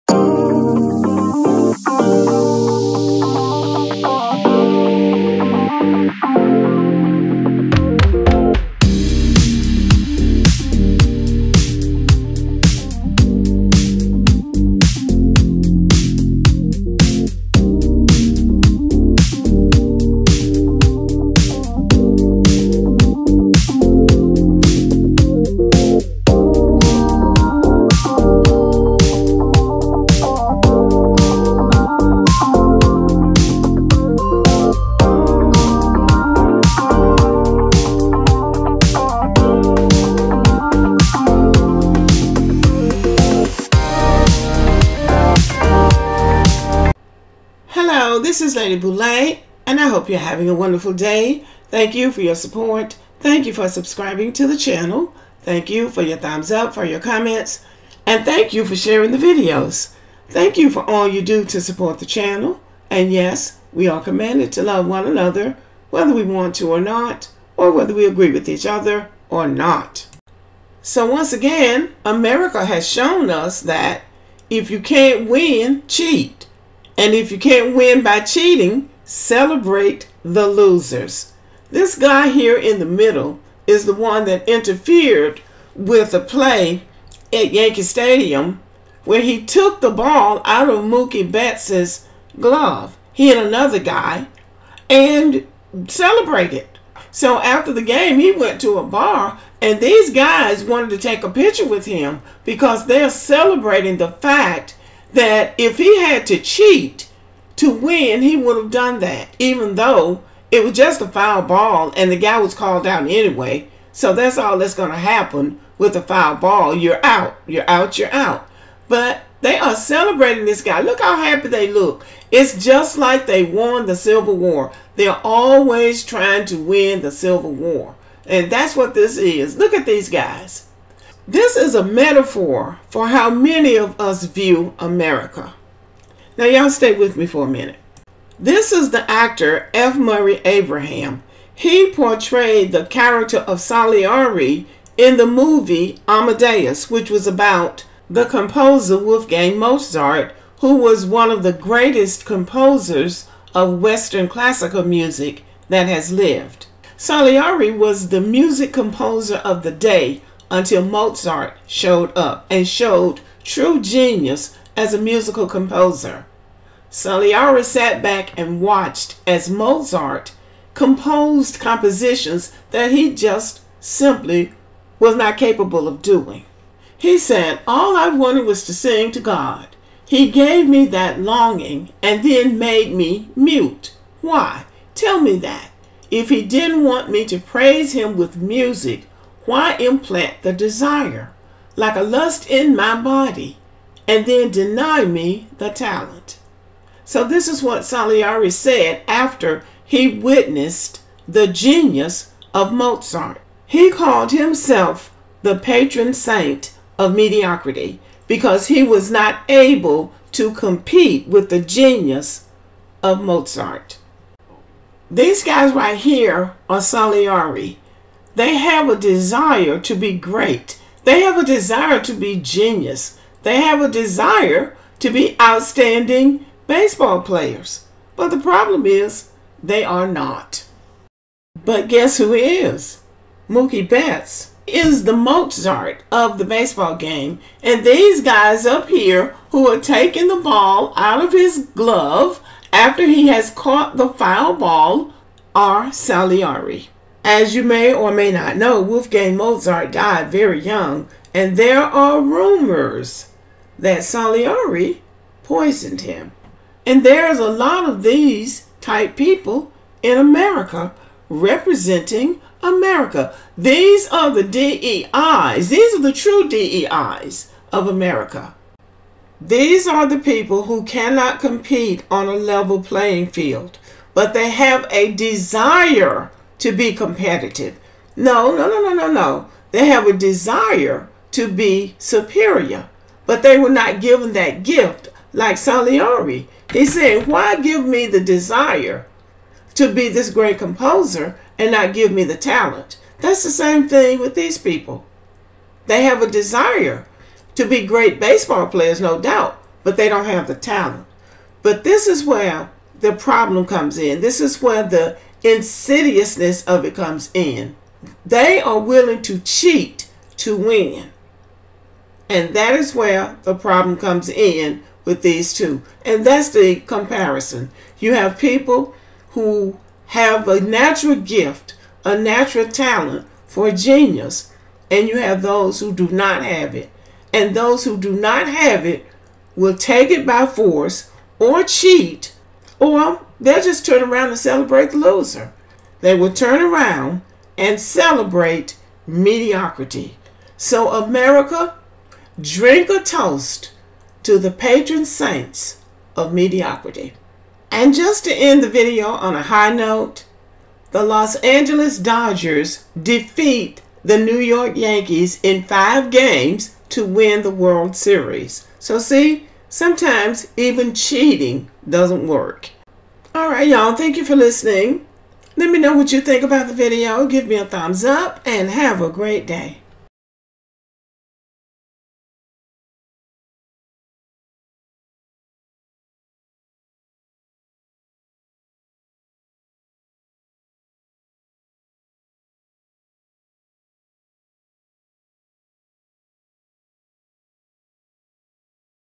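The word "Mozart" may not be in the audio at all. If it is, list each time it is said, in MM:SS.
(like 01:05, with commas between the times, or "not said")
02:29, 02:40, 02:49, 03:22, 03:33, 03:55, 04:09.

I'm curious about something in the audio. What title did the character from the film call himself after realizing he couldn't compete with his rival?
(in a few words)
patron saint of mediocrity.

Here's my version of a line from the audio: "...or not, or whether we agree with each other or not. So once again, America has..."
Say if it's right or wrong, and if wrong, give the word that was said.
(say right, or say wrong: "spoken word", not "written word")
right.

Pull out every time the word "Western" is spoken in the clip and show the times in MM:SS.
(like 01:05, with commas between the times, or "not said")
02:33.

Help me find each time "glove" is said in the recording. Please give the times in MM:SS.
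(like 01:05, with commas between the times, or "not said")
01:32, 04:01.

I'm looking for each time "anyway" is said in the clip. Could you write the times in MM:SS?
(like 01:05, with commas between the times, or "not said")
01:53.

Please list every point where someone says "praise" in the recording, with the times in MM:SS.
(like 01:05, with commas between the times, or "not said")
03:07.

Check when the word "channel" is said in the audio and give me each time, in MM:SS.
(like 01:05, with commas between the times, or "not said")
00:54, 01:02.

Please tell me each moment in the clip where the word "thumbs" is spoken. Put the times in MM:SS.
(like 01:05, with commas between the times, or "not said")
00:56, 06:07.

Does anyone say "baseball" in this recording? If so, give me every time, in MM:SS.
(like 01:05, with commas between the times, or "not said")
03:46, 03:56, 04:58.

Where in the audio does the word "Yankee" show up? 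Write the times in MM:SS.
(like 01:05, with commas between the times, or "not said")
01:27, 05:54.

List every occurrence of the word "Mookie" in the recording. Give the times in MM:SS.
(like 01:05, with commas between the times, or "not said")
01:30, 03:53.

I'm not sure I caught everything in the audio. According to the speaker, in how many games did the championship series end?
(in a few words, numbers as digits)
5.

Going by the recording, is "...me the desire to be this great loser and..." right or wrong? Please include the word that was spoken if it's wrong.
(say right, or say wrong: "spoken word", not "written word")
wrong: "composer", not "loser".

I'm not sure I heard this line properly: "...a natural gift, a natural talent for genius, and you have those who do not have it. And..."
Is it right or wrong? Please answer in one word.
right.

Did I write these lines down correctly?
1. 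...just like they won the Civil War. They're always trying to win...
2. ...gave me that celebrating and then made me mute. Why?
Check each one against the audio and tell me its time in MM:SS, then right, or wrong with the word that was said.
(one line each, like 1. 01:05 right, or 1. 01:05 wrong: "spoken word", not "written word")
1. 02:02 right
2. 03:00 wrong: "longing", not "celebrating".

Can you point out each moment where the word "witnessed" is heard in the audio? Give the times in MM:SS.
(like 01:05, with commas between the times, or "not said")
03:20.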